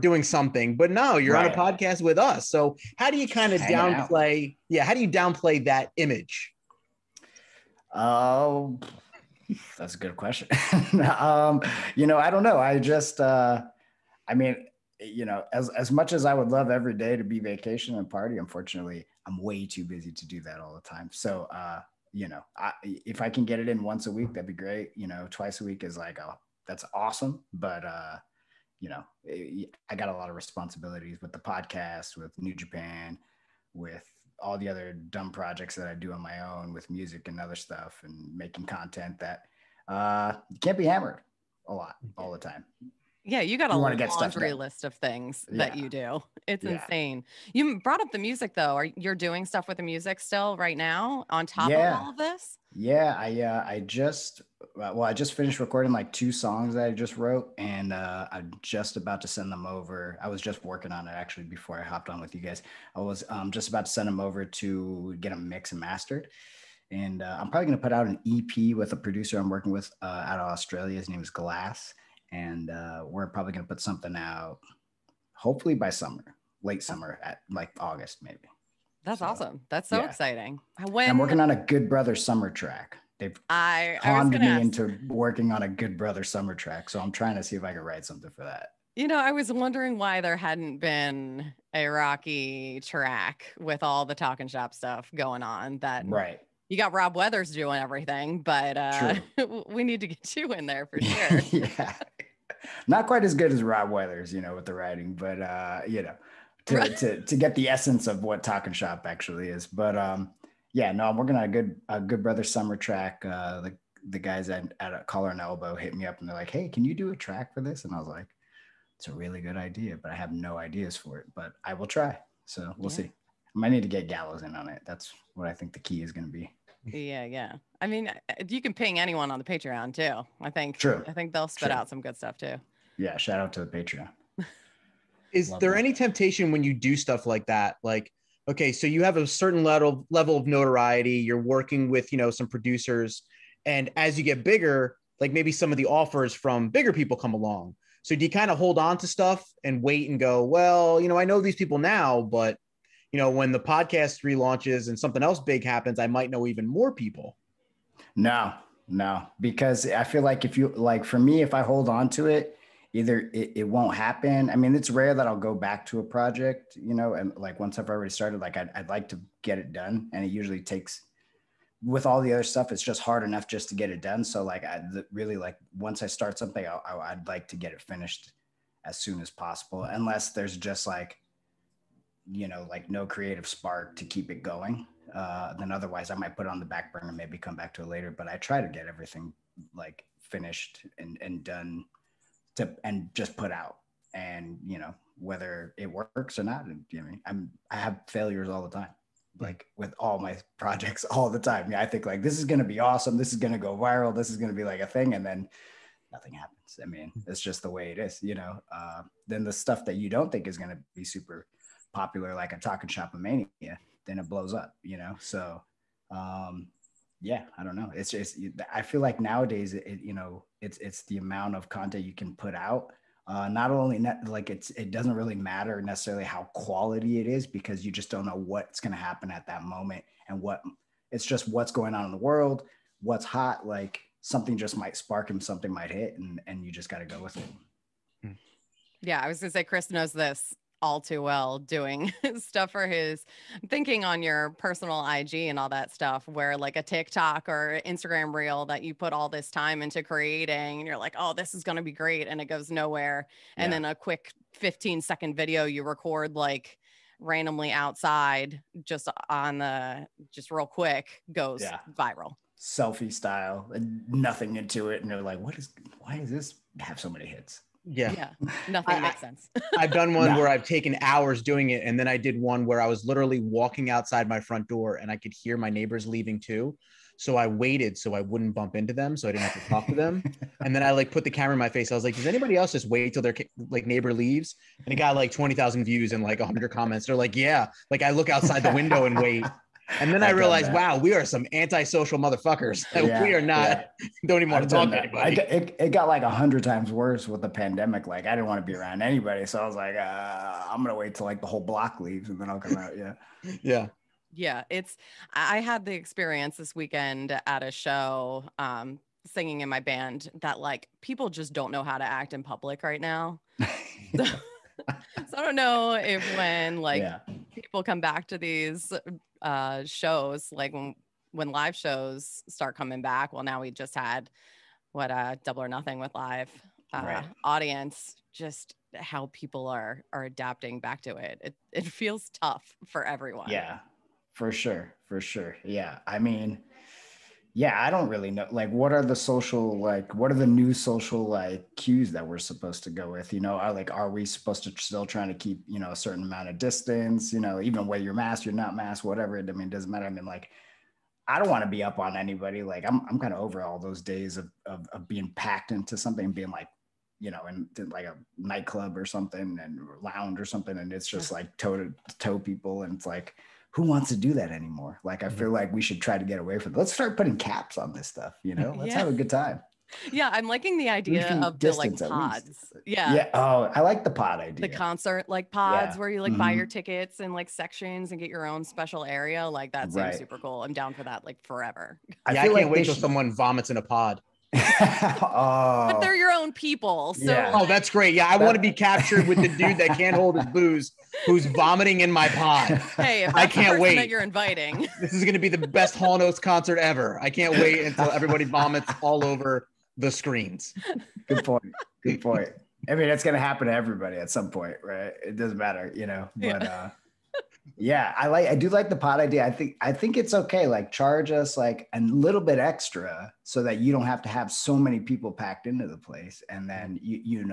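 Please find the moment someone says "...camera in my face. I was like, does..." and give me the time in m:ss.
4:41.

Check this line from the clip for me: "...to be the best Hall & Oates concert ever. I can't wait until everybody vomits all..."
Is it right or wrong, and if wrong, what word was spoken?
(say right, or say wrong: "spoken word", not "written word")
right.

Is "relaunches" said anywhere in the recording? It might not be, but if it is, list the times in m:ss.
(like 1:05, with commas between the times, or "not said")
2:34.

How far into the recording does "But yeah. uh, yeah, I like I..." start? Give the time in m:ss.
6:46.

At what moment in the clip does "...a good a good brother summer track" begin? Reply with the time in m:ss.
1:51.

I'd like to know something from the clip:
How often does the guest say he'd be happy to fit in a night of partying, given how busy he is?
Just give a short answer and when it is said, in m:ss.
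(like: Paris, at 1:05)
once a week, at 0:23.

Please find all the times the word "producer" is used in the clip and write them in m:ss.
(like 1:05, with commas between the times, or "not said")
1:08, 2:22.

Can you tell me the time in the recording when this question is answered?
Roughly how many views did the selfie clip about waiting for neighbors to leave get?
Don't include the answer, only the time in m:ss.
4:45.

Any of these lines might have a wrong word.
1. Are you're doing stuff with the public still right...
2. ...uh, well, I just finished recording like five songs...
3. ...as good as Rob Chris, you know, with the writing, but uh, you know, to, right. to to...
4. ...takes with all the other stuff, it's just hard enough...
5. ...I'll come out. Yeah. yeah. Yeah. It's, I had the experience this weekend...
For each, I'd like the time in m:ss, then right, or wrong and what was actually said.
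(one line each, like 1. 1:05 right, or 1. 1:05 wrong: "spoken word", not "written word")
1. 0:48 wrong: "music", not "public"
2. 0:54 wrong: "two", not "five"
3. 1:43 wrong: "Weathers", not "Chris"
4. 2:50 right
5. 5:02 right.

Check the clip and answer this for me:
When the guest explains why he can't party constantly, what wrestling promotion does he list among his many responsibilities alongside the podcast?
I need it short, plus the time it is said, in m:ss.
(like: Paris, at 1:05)
New Japan, at 0:32.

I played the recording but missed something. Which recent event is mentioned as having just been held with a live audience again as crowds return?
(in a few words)
Double or Nothing.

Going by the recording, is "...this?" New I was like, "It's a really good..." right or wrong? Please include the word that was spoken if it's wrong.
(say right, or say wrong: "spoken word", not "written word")
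wrong: "And", not "New".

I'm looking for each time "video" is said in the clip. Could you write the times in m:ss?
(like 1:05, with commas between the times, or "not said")
4:15.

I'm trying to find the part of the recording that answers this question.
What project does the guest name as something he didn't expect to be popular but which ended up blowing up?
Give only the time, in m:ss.
3:32.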